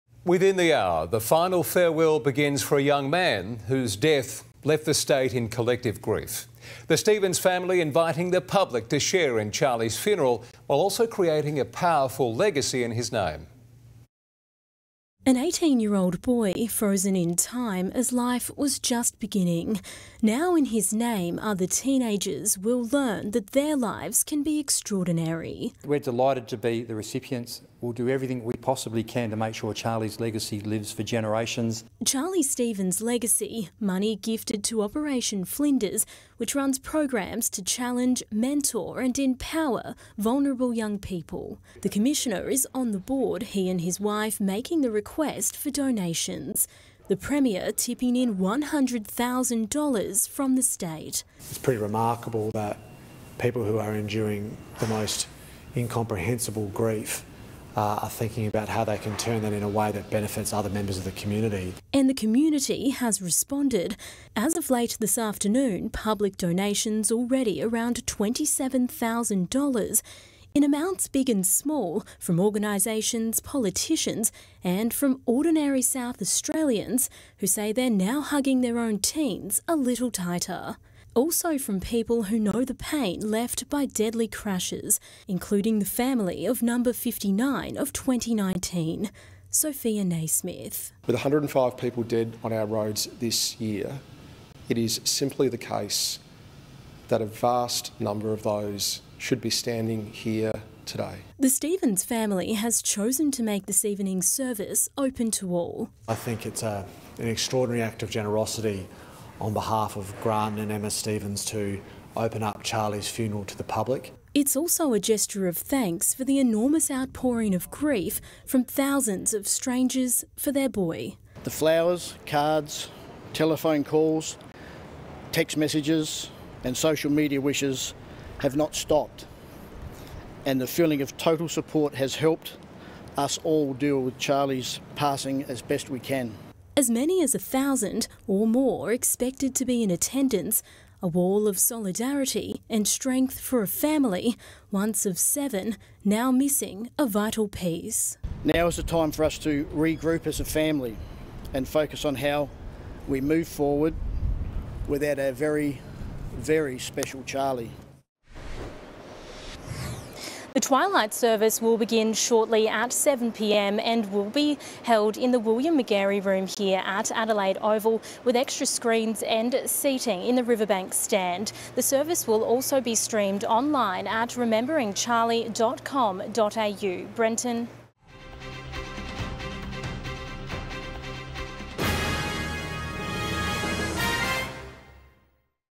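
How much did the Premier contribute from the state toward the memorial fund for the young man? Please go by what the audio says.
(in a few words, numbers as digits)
$100,000.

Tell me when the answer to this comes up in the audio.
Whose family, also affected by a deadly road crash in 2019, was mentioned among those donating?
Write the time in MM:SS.
01:29.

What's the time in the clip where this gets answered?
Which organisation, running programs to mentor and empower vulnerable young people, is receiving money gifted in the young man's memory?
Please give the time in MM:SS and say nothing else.
00:34.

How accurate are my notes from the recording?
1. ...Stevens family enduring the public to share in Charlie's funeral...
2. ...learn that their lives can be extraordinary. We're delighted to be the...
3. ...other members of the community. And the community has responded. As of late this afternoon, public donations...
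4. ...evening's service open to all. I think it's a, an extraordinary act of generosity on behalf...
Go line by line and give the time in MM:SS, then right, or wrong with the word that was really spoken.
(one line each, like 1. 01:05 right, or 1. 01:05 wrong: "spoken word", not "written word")
1. 00:06 wrong: "inviting", not "enduring"
2. 00:22 right
3. 01:00 right
4. 01:43 right.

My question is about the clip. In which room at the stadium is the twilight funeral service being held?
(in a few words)
William Magarey room.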